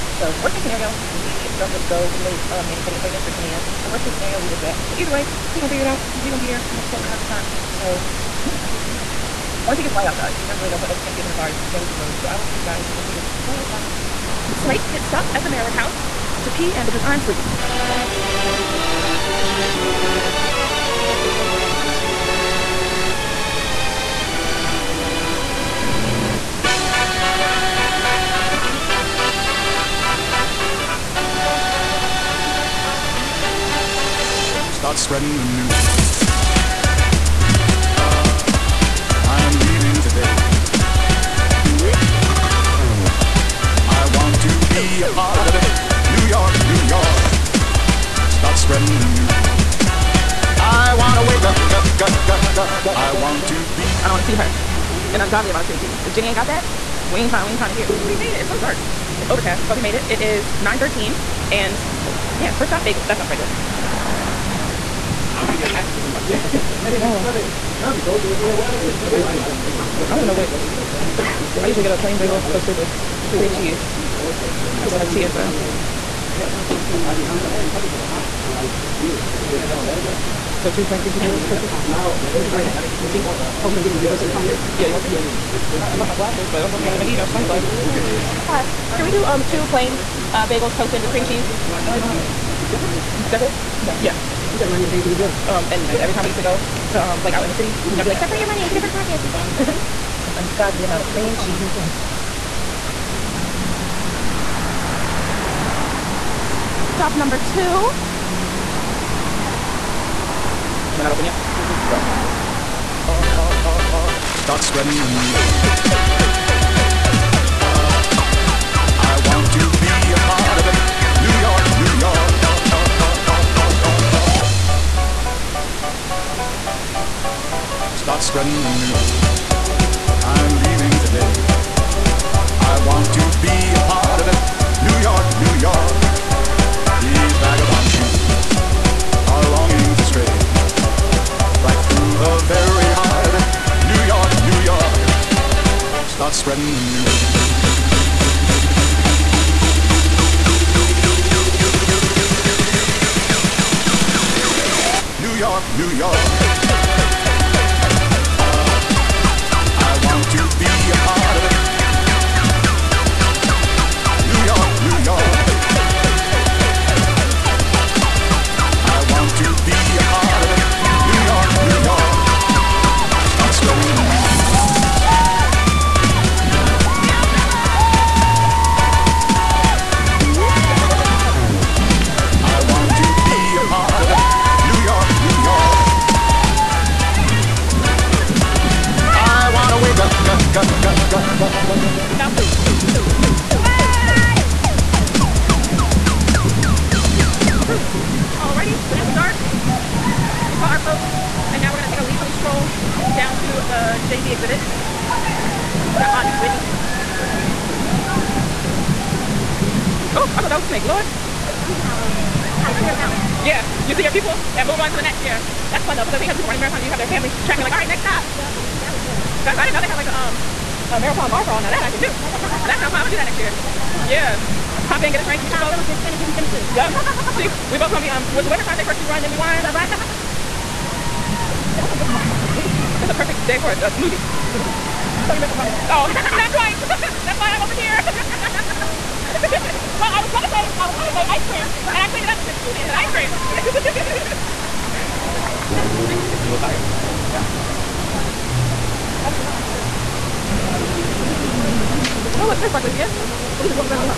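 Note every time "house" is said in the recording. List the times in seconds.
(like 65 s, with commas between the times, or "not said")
15 s.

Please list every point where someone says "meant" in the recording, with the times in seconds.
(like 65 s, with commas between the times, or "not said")
235 s.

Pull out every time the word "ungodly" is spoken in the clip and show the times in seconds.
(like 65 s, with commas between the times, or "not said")
55 s, 100 s.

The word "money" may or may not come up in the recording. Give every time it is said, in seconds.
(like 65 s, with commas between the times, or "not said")
98 s.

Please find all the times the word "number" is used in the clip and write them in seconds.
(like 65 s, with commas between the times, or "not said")
107 s.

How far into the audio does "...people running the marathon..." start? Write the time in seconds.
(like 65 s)
216 s.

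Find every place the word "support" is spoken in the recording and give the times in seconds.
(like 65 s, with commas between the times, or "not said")
6 s.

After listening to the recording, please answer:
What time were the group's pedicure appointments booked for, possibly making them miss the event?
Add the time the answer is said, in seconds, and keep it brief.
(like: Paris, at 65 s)
10 a.m., at 3 s.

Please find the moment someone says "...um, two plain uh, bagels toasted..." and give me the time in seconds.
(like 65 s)
89 s.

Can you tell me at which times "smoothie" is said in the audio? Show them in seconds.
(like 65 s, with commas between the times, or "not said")
233 s.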